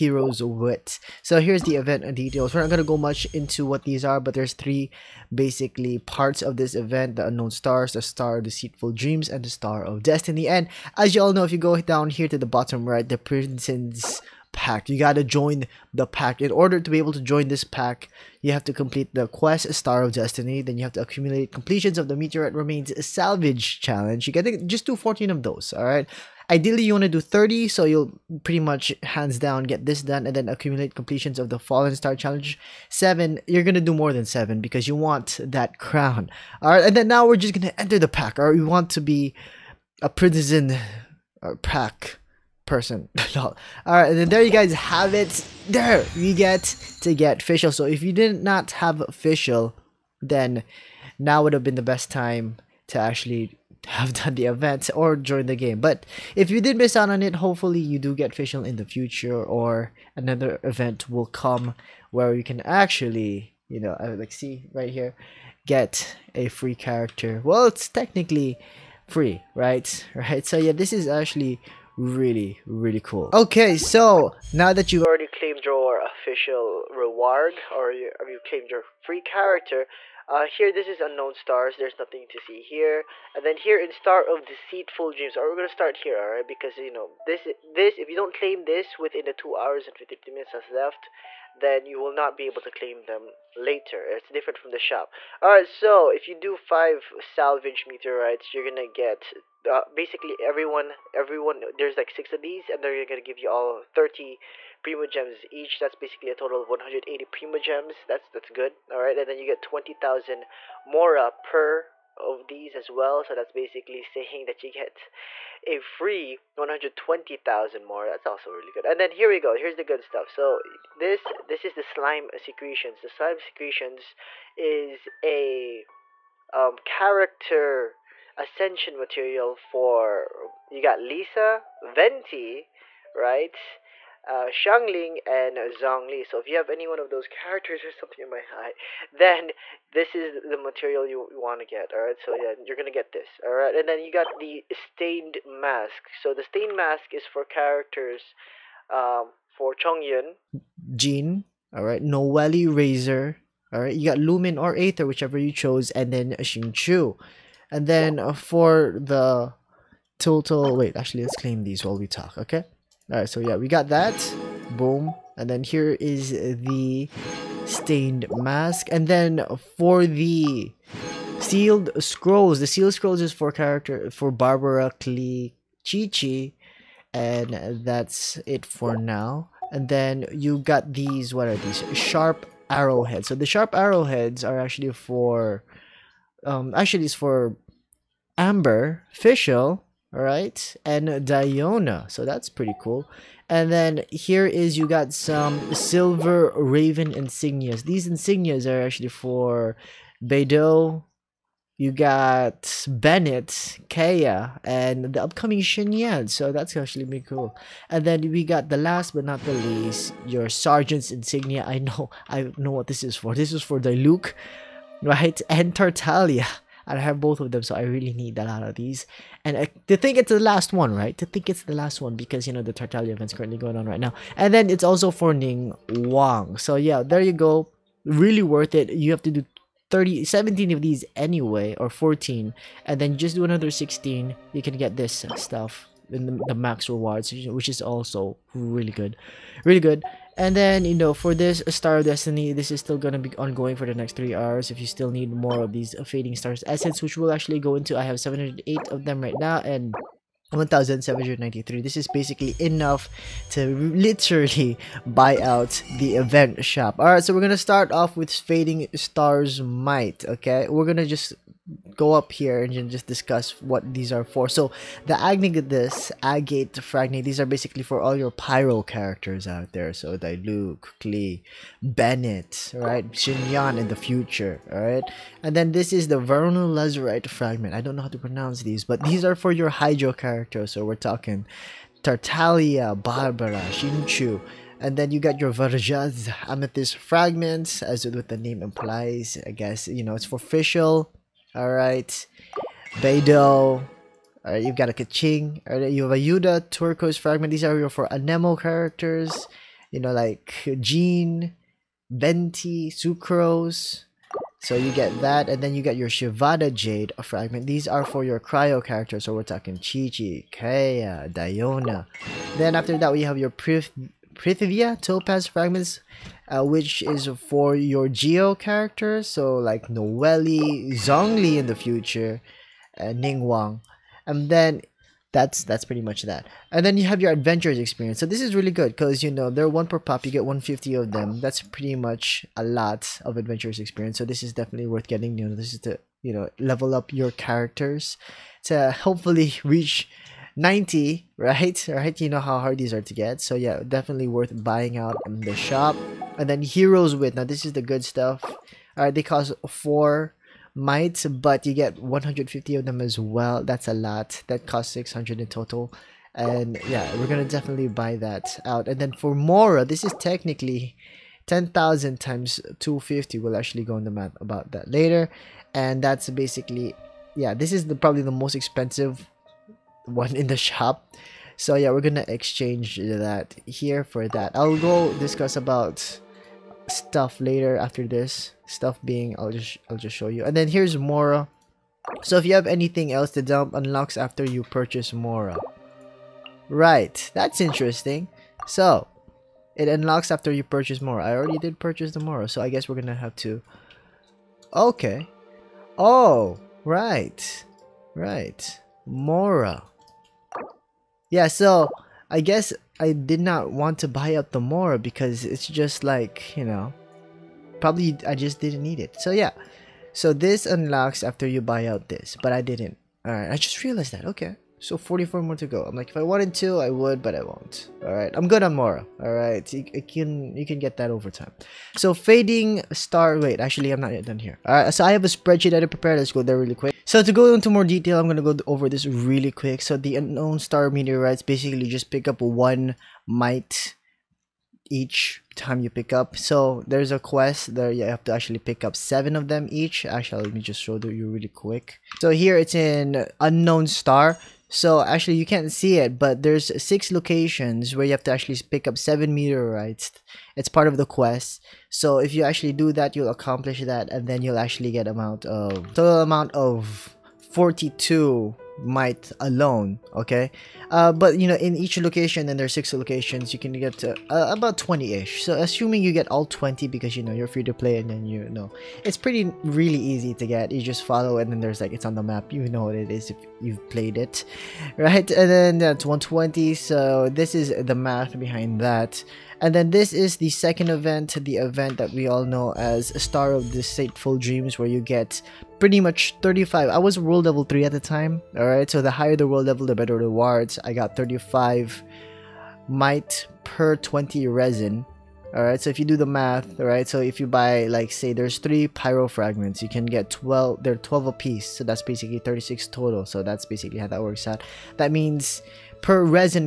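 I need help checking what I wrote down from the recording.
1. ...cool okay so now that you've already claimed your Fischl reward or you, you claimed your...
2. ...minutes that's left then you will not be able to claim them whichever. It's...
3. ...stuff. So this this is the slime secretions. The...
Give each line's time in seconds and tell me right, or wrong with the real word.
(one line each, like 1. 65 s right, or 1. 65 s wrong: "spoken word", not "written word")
1. 72 s right
2. 90 s wrong: "later", not "whichever"
3. 120 s right.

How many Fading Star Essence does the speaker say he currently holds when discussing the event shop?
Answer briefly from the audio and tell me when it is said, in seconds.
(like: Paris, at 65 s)
708, at 248 s.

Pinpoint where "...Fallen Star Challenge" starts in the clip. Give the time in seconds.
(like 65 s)
31 s.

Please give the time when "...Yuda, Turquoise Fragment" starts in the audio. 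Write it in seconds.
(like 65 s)
296 s.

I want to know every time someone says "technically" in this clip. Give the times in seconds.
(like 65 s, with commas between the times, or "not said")
67 s, 360 s.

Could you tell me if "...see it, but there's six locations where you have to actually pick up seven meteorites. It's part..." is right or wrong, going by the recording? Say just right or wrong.
right.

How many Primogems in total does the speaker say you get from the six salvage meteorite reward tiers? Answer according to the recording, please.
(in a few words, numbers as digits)
180.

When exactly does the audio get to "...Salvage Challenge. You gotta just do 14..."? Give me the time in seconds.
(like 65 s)
23 s.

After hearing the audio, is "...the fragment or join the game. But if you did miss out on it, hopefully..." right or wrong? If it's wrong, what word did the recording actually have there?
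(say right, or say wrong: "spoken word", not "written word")
wrong: "event", not "fragment".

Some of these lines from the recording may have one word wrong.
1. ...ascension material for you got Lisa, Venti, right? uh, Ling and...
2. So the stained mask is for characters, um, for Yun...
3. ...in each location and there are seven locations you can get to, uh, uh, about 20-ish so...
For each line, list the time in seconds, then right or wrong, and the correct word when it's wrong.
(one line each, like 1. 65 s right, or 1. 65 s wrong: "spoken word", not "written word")
1. 128 s right
2. 146 s right
3. 461 s wrong: "six", not "seven".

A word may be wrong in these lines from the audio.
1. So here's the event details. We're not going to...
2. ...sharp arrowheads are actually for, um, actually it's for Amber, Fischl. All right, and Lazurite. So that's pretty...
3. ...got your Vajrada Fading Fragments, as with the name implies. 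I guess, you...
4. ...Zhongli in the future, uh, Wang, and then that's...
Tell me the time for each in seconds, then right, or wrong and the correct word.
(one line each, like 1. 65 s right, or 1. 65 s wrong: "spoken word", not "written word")
1. 1 s right
2. 183 s wrong: "Diona", not "Lazurite"
3. 285 s wrong: "Amethyst", not "Fading"
4. 320 s wrong: "Ningguang", not "Wang".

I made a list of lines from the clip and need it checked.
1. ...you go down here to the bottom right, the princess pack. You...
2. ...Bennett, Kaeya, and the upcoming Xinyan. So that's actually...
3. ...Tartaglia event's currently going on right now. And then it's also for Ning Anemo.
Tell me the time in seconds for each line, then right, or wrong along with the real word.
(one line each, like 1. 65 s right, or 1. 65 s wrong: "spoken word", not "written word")
1. 11 s right
2. 202 s right
3. 222 s wrong: "Wang", not "Anemo".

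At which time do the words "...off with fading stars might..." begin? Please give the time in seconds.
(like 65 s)
257 s.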